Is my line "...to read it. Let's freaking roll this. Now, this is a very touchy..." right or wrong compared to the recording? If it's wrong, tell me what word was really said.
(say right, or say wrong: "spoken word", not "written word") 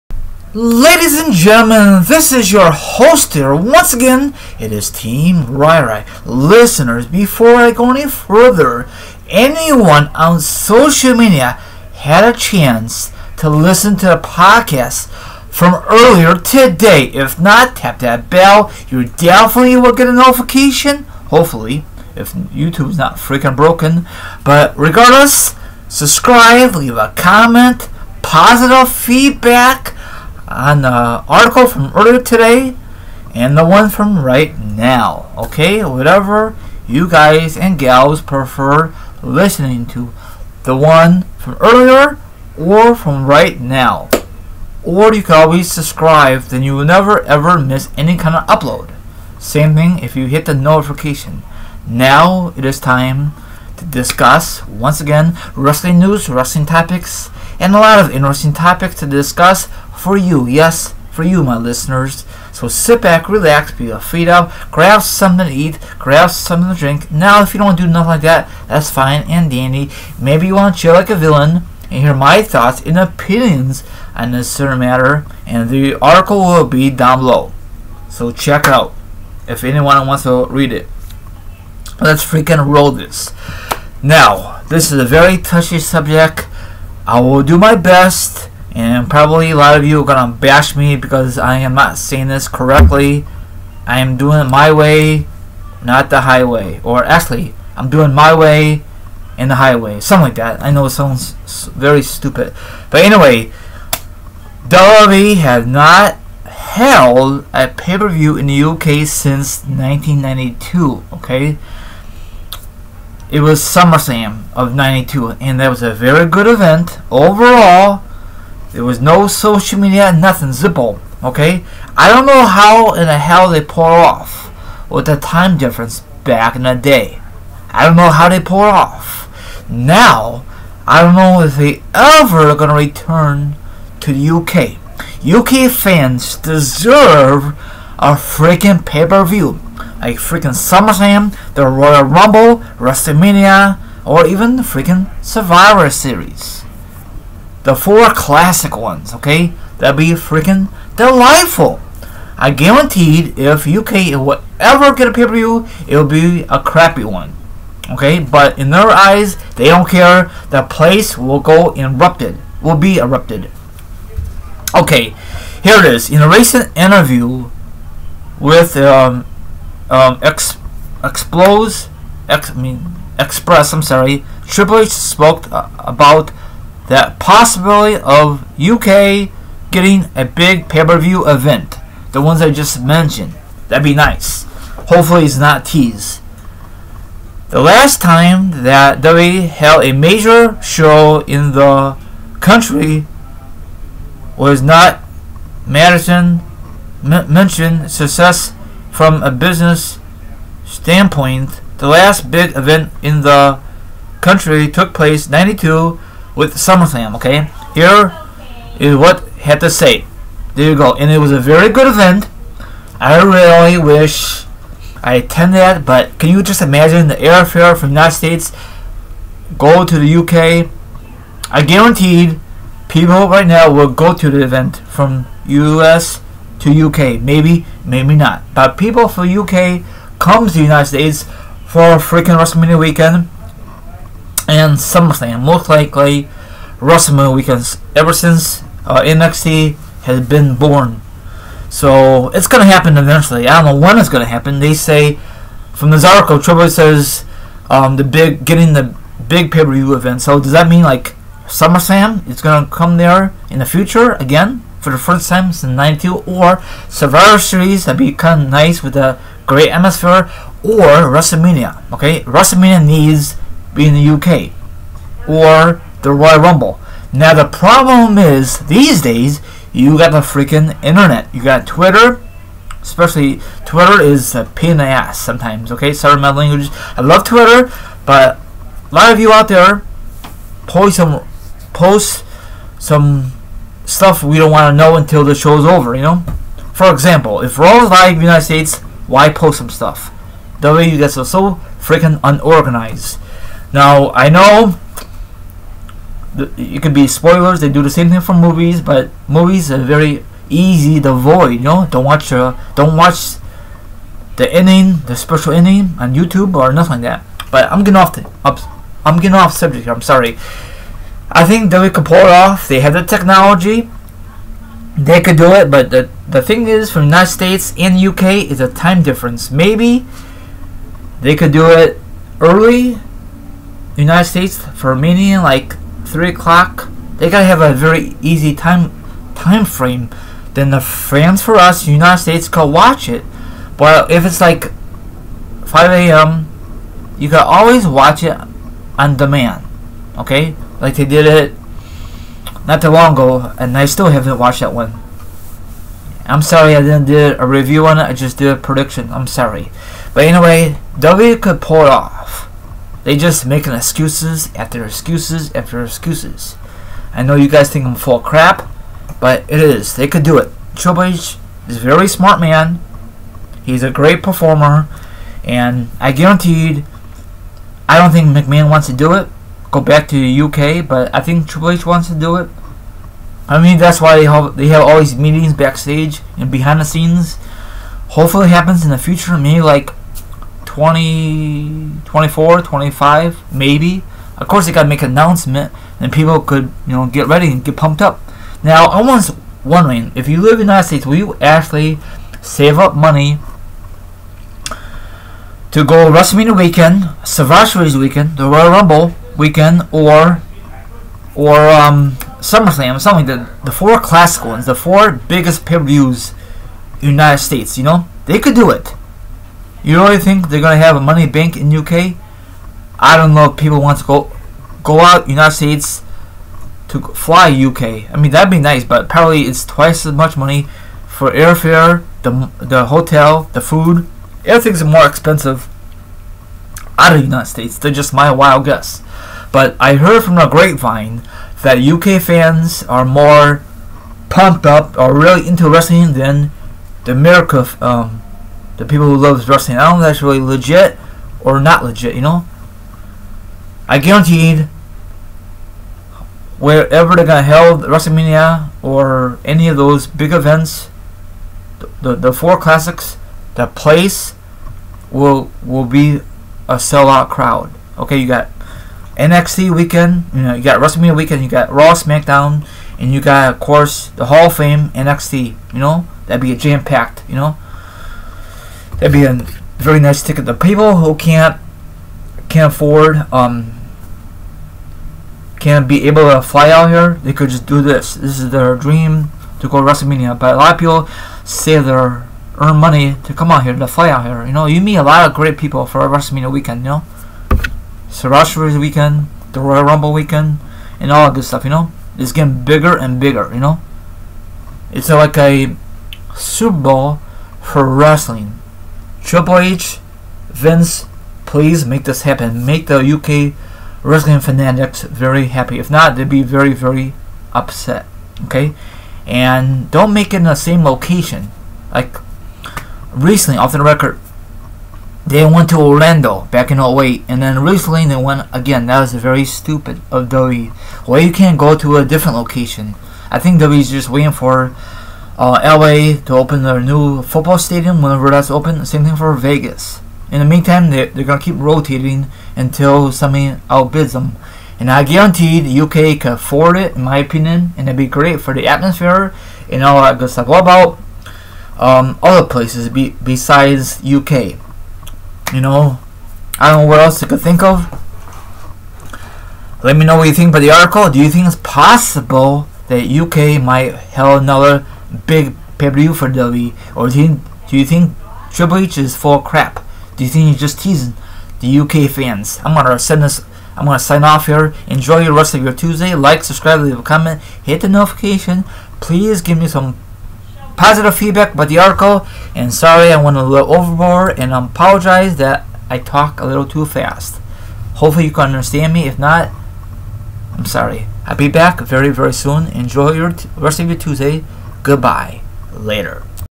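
right.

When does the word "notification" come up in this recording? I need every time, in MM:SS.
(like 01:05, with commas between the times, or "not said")
00:20, 00:50, 09:27.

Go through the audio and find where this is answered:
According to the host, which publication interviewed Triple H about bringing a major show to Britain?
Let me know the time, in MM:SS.
02:53.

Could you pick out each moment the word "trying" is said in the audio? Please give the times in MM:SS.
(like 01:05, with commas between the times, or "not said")
not said.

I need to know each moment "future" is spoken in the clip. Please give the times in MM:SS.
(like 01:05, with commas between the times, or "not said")
04:13, 06:18.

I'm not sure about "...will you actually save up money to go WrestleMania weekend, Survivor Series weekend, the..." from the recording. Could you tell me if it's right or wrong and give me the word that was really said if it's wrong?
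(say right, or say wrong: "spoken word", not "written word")
right.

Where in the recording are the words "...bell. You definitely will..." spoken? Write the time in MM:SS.
00:18.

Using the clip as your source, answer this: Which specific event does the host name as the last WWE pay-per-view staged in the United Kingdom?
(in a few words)
SummerSlam of 92.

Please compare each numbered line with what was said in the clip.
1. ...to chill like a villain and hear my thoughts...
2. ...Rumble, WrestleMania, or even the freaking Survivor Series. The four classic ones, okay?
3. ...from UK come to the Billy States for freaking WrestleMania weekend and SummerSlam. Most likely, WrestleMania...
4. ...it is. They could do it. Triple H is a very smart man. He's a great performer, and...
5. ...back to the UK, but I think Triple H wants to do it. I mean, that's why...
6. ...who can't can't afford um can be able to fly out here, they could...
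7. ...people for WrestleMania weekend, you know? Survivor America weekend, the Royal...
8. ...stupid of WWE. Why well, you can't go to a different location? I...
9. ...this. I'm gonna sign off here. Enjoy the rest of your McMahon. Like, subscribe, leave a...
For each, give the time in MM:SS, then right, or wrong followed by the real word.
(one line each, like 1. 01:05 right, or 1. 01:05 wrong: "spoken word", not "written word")
1. 01:10 right
2. 02:22 right
3. 03:49 wrong: "United", not "Billy"
4. 05:59 right
5. 06:09 right
6. 07:50 right
7. 08:05 wrong: "Series", not "America"
8. 08:39 right
9. 09:23 wrong: "Tuesday", not "McMahon".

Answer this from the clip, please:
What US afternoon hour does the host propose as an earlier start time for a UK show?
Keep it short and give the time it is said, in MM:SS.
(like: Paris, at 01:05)
3 o'clock, at 05:26.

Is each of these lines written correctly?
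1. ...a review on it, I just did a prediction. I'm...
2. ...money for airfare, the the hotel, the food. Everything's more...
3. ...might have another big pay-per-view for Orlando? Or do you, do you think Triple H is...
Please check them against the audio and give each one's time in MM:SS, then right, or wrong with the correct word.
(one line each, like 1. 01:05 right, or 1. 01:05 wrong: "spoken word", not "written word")
1. 05:47 right
2. 07:00 right
3. 09:13 wrong: "WWE", not "Orlando".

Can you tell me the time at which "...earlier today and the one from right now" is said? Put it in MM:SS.
00:31.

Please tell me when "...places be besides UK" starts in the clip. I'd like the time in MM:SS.
09:02.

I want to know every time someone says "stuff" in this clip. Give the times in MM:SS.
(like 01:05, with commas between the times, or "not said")
04:43, 04:49, 08:11, 09:00.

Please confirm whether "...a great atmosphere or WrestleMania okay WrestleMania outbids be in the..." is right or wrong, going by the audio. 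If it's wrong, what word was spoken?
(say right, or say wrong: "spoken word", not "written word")
wrong: "needs", not "outbids".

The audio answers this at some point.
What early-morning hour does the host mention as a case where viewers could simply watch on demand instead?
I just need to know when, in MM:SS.
05:35.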